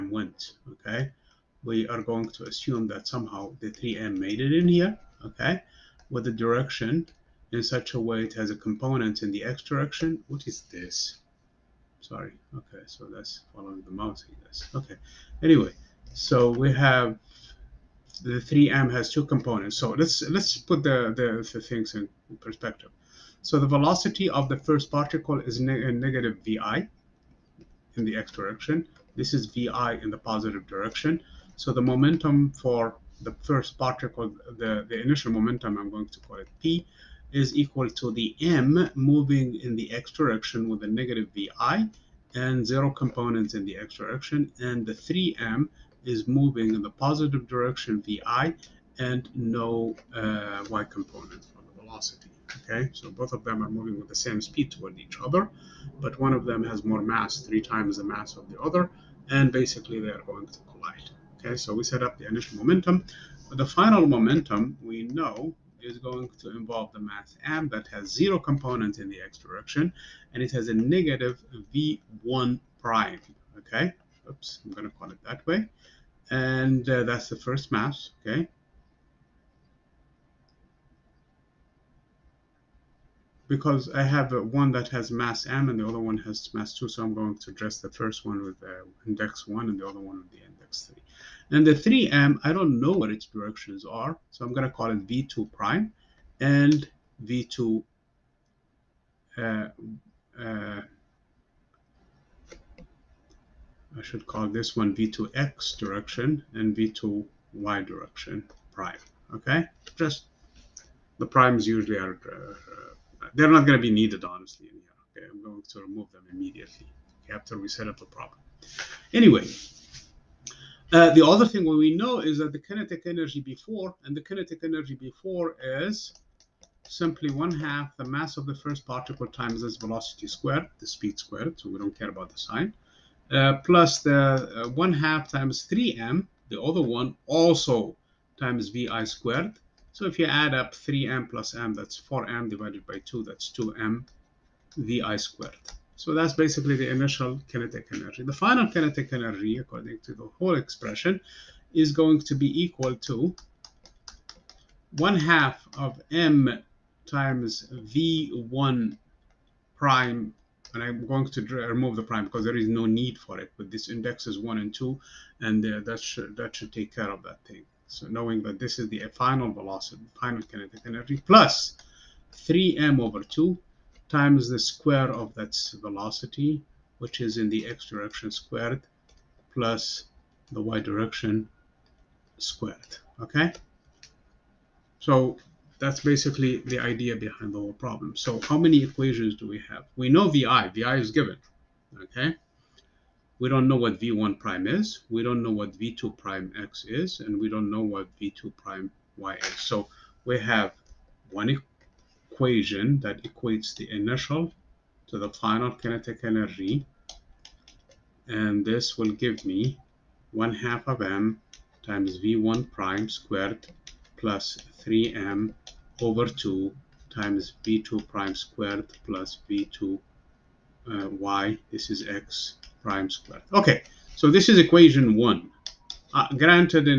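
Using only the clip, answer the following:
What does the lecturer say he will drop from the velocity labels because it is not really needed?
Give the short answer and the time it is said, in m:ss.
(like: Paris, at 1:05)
the prime, at 2:41.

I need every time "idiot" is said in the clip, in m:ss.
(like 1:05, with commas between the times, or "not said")
not said.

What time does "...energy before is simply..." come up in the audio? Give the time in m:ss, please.
2:04.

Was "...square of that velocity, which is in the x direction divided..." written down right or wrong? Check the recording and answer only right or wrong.
wrong.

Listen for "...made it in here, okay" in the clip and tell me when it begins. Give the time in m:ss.
0:04.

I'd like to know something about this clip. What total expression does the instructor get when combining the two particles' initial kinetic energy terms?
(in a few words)
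2m vi squared.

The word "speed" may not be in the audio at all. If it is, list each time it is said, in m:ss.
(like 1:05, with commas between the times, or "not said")
0:54, 2:10.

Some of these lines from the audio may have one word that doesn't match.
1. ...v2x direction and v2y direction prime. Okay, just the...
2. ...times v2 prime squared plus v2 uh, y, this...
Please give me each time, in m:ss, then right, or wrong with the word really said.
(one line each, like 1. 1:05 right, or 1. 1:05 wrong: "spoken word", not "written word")
1. 1:44 right
2. 3:37 right.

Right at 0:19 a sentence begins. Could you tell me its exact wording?
So let's let's put the, the, the things in perspective.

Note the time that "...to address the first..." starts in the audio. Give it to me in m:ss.
1:27.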